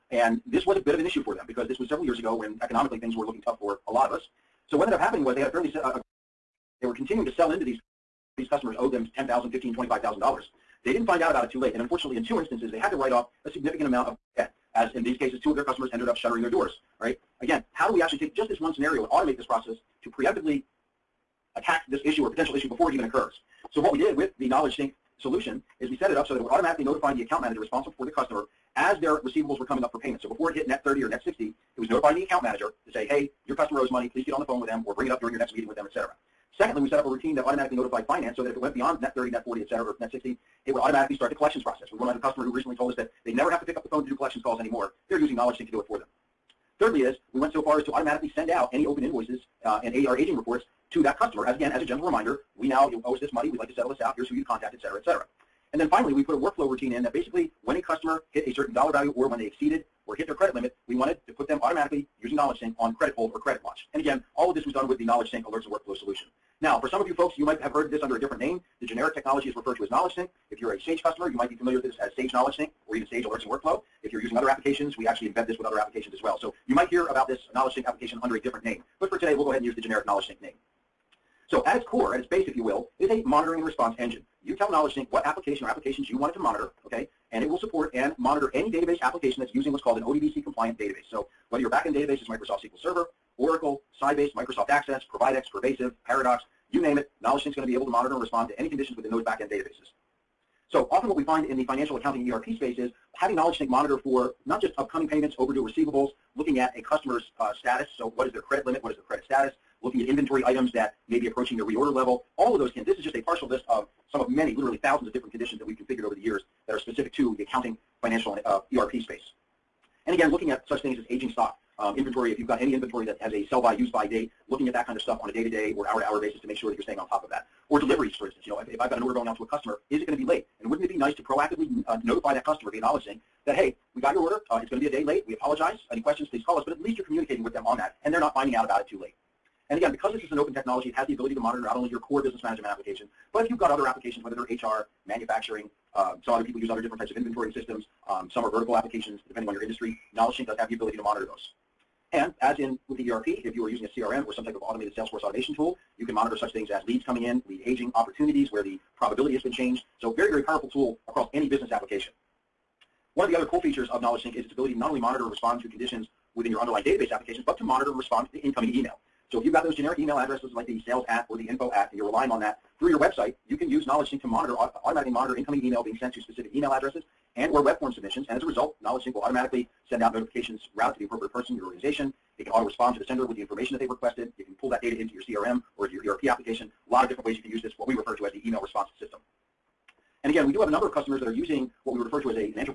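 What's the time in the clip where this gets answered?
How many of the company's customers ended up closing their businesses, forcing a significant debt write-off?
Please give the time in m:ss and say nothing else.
0:15.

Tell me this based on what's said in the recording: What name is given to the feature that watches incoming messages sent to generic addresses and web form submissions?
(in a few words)
Email response system.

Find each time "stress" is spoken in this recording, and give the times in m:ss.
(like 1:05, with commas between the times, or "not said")
not said.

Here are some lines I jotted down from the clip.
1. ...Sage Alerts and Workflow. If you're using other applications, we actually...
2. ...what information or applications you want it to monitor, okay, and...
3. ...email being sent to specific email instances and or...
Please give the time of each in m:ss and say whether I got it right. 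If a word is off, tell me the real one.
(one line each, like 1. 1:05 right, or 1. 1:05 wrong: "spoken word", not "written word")
1. 1:13 right
2. 1:25 wrong: "application", not "information"
3. 2:55 wrong: "addresses", not "instances".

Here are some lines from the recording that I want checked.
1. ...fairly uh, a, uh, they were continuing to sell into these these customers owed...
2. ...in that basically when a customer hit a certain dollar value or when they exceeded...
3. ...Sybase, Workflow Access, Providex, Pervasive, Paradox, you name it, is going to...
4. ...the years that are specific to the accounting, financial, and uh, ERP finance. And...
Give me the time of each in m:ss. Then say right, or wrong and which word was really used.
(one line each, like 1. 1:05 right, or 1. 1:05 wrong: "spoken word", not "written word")
1. 0:05 right
2. 0:56 right
3. 1:34 wrong: "Microsoft", not "Workflow"
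4. 1:56 wrong: "space", not "finance".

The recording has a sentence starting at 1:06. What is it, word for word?
Now, for some of you folks, you might have heard this under a different name.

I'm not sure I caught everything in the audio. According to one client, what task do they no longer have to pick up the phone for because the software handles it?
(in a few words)
Collections calls.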